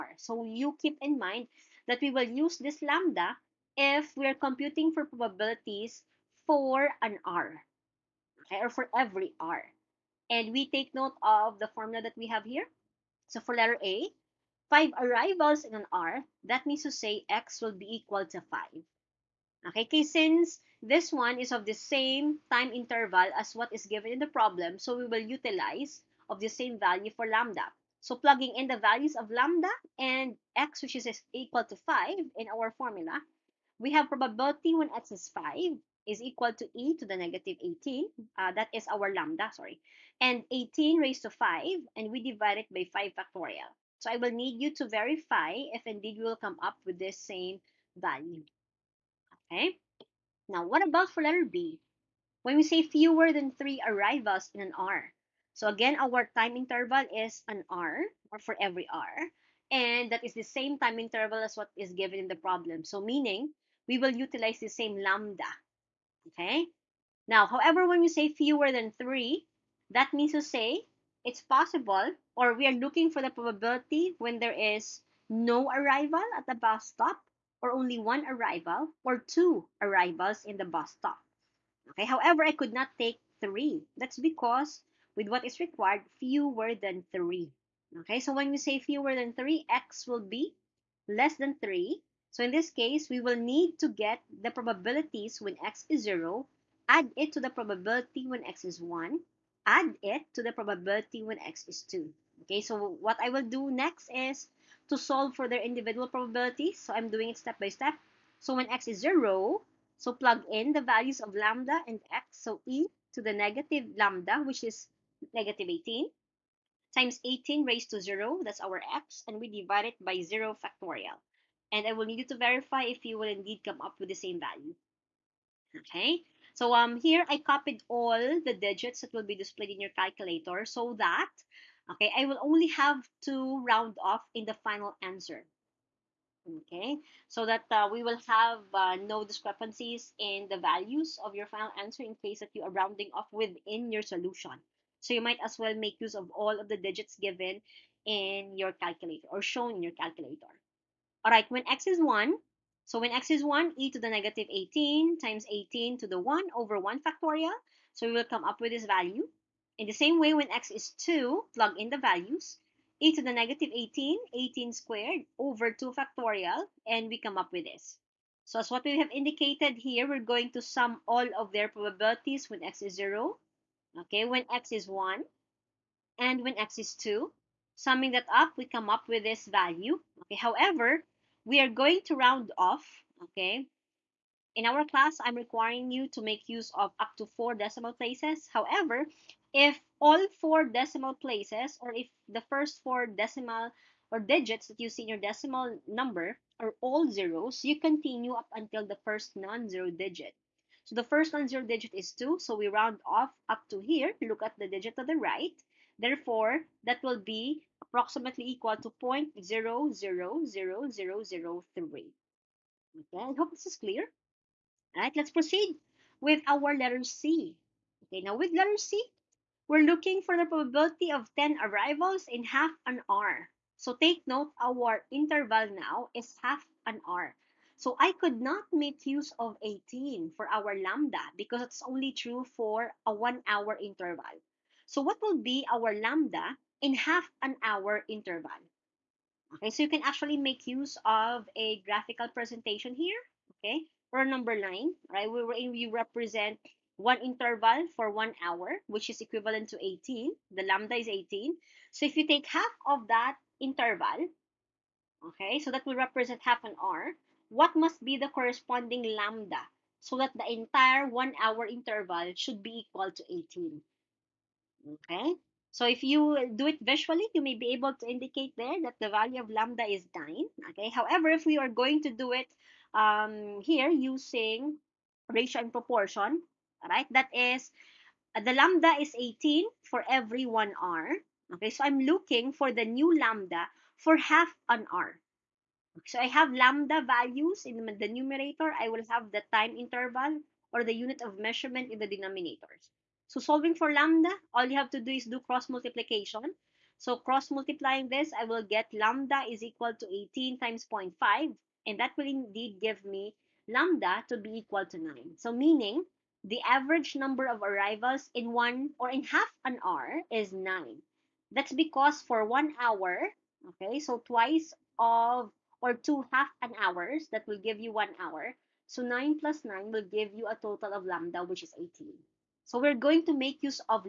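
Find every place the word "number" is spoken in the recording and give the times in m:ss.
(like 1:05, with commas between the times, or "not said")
3:15, 4:04, 5:07.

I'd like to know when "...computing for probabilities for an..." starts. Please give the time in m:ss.
0:04.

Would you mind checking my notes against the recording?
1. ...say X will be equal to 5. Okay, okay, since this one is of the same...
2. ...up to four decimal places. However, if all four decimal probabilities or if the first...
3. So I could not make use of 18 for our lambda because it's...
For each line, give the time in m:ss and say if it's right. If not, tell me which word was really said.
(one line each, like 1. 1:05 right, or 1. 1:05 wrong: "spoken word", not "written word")
1. 0:16 right
2. 3:06 wrong: "places", not "probabilities"
3. 3:47 right.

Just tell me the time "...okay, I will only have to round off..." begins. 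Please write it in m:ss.
2:11.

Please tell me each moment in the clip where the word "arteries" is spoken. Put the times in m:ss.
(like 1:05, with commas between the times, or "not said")
not said.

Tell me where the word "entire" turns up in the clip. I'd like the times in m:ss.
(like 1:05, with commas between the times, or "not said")
4:20.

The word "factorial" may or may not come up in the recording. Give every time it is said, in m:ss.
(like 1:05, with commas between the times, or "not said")
0:43, 2:00, 2:37, 2:45.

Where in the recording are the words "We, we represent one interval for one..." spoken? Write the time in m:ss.
4:05.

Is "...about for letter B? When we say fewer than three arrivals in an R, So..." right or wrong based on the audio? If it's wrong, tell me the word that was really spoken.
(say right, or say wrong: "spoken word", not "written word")
right.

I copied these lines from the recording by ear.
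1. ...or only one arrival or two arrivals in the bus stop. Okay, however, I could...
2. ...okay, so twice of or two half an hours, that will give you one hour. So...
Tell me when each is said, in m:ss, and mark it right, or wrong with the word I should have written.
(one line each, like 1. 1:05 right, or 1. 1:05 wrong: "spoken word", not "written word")
1. 1:17 right
2. 5:13 right.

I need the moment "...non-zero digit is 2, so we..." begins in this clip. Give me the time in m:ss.
3:21.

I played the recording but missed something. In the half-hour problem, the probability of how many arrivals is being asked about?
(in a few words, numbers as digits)
10.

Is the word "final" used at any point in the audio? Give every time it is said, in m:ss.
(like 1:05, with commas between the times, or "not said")
2:14, 2:21.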